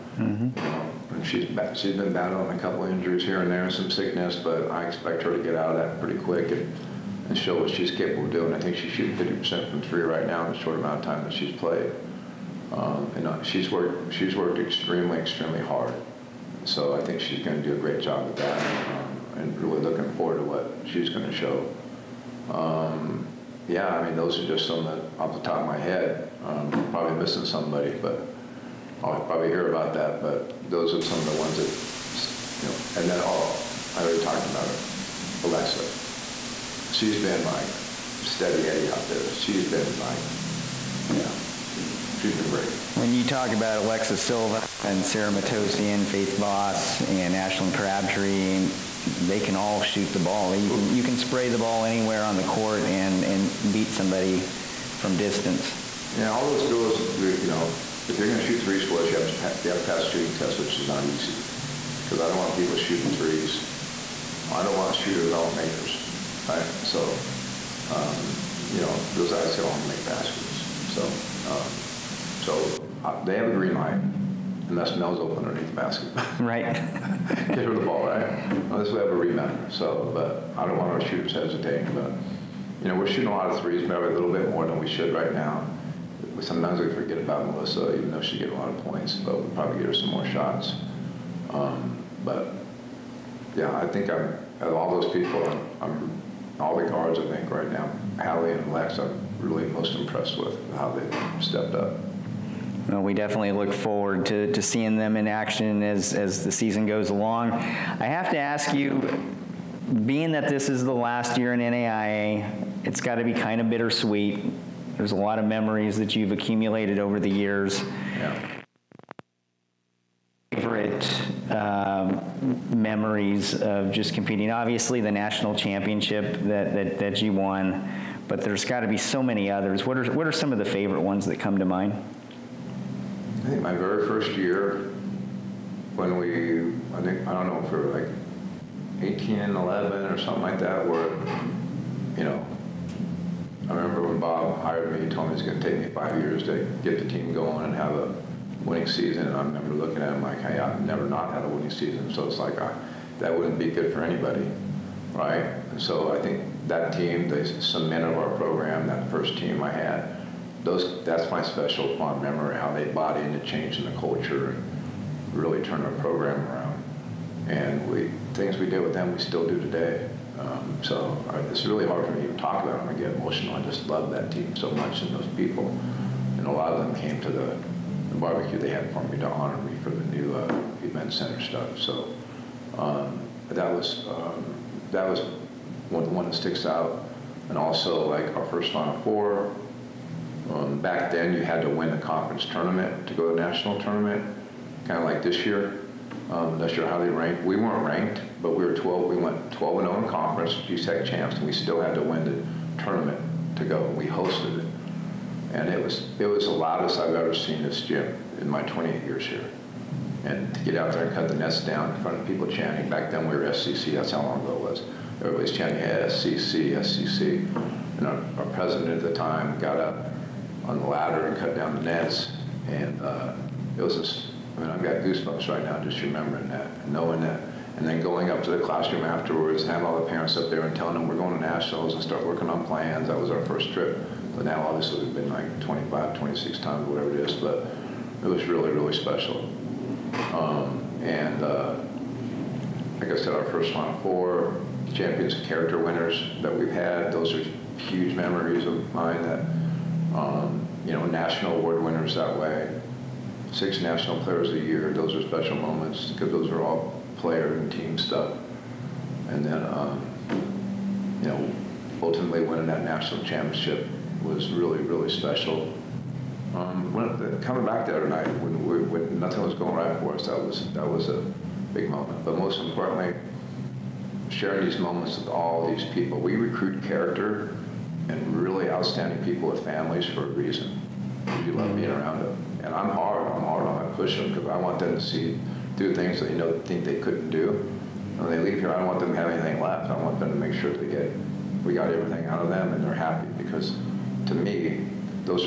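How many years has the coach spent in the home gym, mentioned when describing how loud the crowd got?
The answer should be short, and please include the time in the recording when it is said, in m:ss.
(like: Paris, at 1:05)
28, at 3:28.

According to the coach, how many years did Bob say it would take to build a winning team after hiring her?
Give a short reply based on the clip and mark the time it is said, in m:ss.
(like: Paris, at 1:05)
5 years, at 2:25.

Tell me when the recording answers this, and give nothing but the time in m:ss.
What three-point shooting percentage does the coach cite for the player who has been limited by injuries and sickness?
0:09.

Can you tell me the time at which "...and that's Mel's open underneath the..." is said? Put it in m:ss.
1:13.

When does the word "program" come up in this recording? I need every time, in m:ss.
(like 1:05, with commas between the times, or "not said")
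2:38, 2:46.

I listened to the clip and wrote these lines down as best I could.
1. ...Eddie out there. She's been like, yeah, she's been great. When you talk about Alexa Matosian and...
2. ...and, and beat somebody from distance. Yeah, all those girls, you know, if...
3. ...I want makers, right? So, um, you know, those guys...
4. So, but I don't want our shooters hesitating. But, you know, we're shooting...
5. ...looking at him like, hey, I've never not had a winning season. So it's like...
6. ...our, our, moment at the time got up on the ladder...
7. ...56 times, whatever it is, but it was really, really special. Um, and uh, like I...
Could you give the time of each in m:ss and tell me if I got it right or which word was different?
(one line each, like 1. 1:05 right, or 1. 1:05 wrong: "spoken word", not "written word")
1. 0:38 wrong: "Silva", not "Matosian"
2. 0:52 right
3. 1:05 right
4. 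1:19 right
5. 2:29 right
6. 3:38 wrong: "president", not "moment"
7. 3:56 wrong: "26", not "56".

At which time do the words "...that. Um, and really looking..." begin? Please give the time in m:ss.
0:18.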